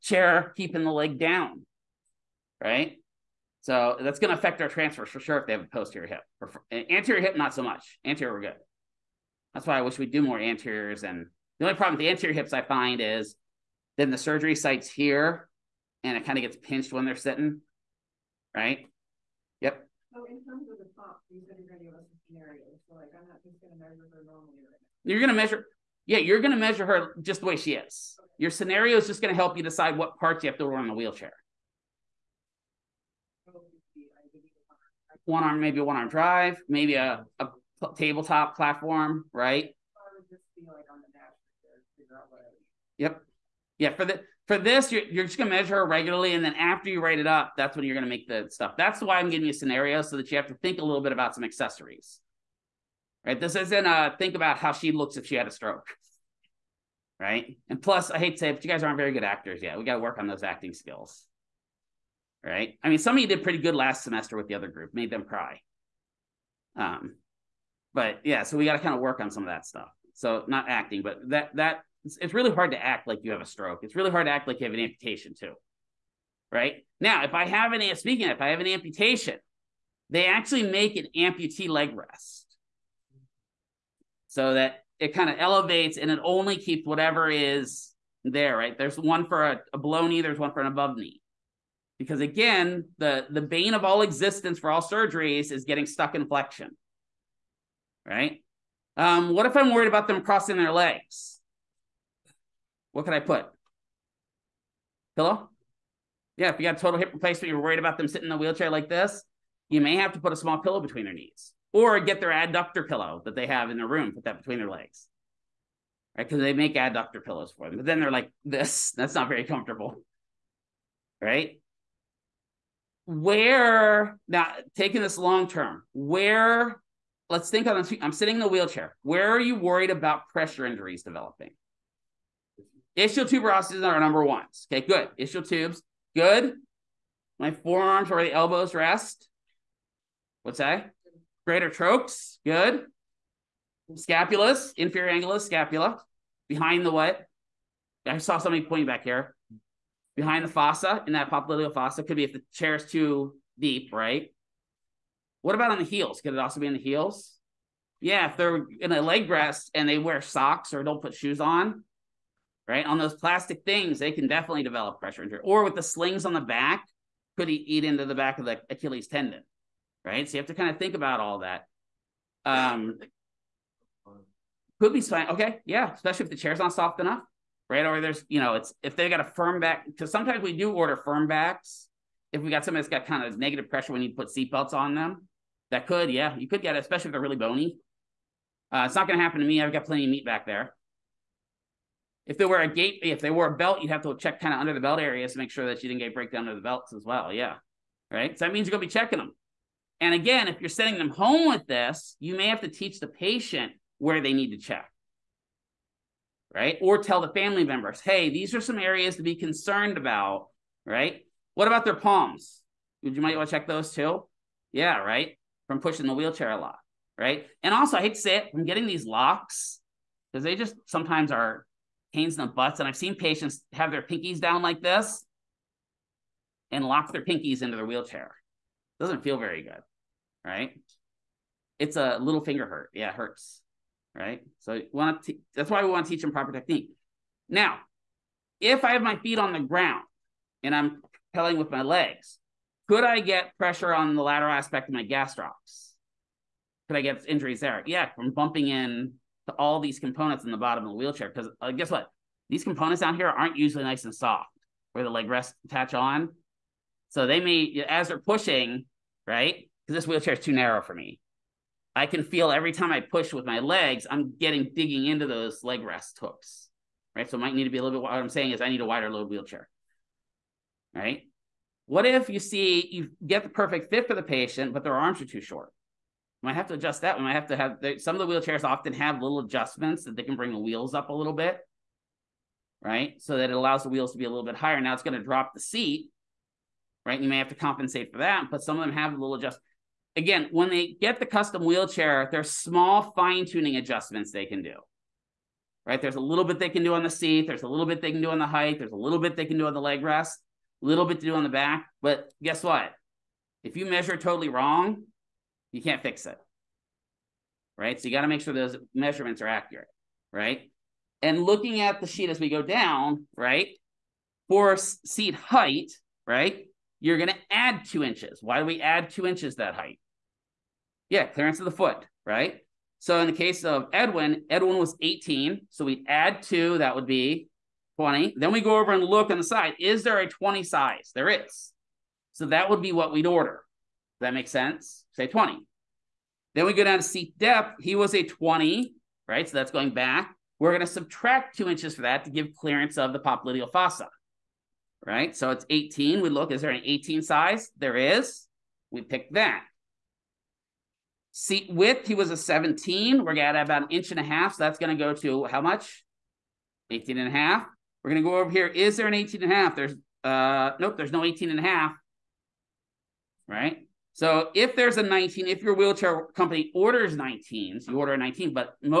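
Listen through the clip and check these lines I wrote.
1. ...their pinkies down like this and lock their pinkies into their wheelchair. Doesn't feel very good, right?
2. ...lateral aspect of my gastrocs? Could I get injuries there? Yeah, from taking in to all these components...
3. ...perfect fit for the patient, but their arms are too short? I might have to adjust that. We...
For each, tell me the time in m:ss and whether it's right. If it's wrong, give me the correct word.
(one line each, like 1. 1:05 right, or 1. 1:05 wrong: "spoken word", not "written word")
1. 3:43 right
2. 4:04 wrong: "bumping", not "taking"
3. 4:33 right.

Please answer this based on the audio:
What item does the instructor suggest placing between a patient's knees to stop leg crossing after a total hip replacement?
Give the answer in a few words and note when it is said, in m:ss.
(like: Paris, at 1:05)
small pillow, at 1:50.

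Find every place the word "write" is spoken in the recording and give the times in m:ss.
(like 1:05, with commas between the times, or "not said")
0:46.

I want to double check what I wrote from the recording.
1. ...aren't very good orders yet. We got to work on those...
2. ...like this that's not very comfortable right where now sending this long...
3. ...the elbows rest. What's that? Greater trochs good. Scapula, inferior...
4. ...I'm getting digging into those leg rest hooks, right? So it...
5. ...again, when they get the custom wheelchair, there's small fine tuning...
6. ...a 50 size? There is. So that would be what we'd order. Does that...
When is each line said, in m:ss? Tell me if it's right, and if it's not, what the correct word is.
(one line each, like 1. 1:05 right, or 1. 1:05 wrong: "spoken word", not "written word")
1. 0:58 wrong: "actors", not "orders"
2. 1:58 wrong: "taking", not "sending"
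3. 2:18 right
4. 4:24 right
5. 4:50 right
6. 5:30 wrong: "20", not "50".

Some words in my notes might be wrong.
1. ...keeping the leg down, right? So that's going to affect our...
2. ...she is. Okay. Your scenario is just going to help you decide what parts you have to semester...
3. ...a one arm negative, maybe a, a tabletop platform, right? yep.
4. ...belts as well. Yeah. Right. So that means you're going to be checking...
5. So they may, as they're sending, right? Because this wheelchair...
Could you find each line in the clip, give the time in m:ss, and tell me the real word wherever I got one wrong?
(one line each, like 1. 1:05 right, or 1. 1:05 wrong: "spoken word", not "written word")
1. 0:00 right
2. 0:27 wrong: "order", not "semester"
3. 0:35 wrong: "drive", not "negative"
4. 3:16 right
5. 4:17 wrong: "pushing", not "sending".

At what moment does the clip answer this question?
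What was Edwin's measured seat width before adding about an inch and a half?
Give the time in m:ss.
5:52.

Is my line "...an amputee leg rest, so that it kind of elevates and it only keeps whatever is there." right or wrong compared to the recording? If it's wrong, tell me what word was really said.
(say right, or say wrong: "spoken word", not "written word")
right.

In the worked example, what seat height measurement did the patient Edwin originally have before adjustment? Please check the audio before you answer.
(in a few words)
18.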